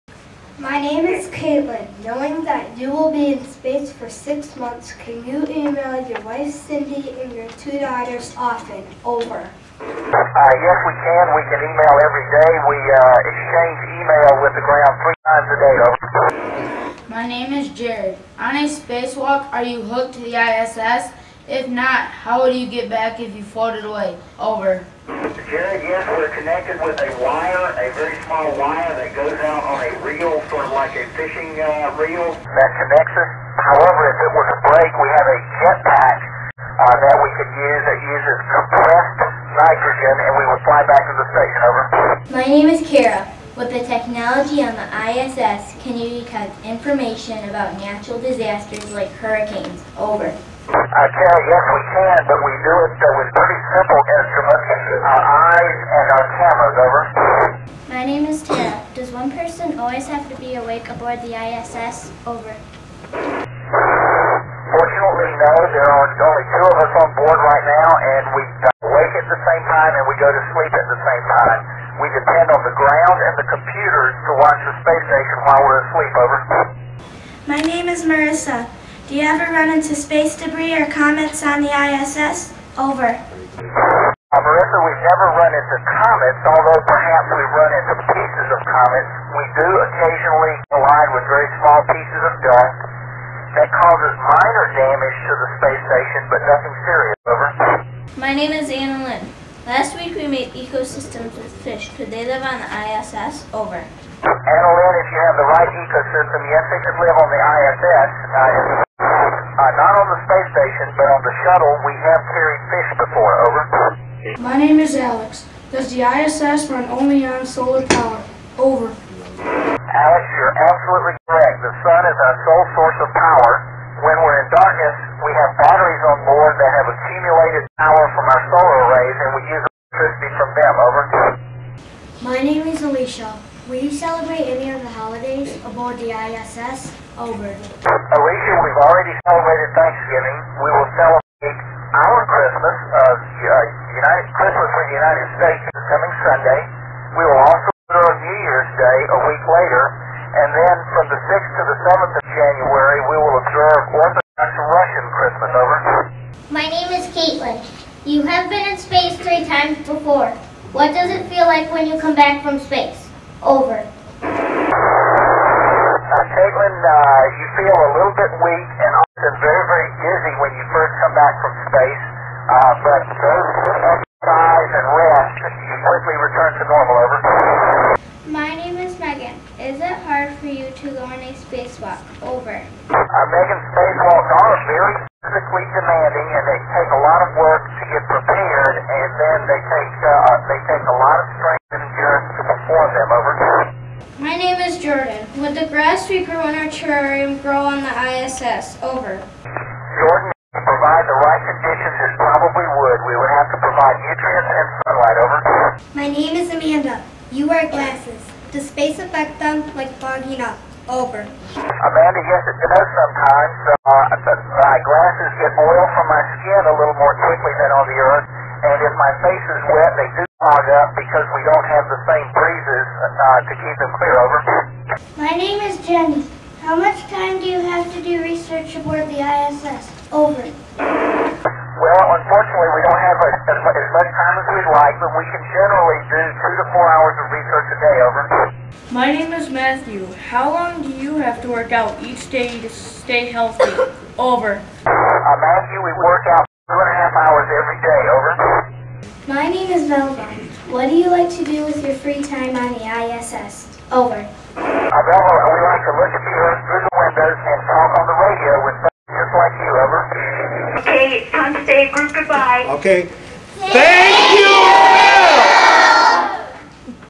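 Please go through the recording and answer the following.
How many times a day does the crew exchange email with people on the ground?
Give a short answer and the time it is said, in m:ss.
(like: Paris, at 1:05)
3, at 0:15.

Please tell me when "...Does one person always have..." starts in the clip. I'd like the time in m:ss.
0:58.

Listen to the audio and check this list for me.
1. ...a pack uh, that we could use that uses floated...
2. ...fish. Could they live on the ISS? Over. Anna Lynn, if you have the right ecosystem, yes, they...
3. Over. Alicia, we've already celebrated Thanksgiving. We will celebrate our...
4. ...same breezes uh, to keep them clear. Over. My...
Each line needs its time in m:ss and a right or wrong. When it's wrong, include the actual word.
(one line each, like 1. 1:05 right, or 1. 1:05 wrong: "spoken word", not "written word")
1. 0:35 wrong: "compressed", not "floated"
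2. 1:41 right
3. 2:17 right
4. 3:42 right.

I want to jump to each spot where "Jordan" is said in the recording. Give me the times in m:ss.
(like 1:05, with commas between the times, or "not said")
3:14, 3:19.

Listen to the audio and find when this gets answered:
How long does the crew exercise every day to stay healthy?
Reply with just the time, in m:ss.
4:06.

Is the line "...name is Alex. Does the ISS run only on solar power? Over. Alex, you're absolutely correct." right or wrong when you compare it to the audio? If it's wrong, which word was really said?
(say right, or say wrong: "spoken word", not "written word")
right.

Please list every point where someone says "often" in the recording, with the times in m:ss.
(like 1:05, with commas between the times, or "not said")
0:08, 2:48.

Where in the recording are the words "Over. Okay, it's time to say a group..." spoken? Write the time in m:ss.
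4:19.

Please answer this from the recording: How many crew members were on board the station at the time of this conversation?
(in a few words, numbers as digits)
2.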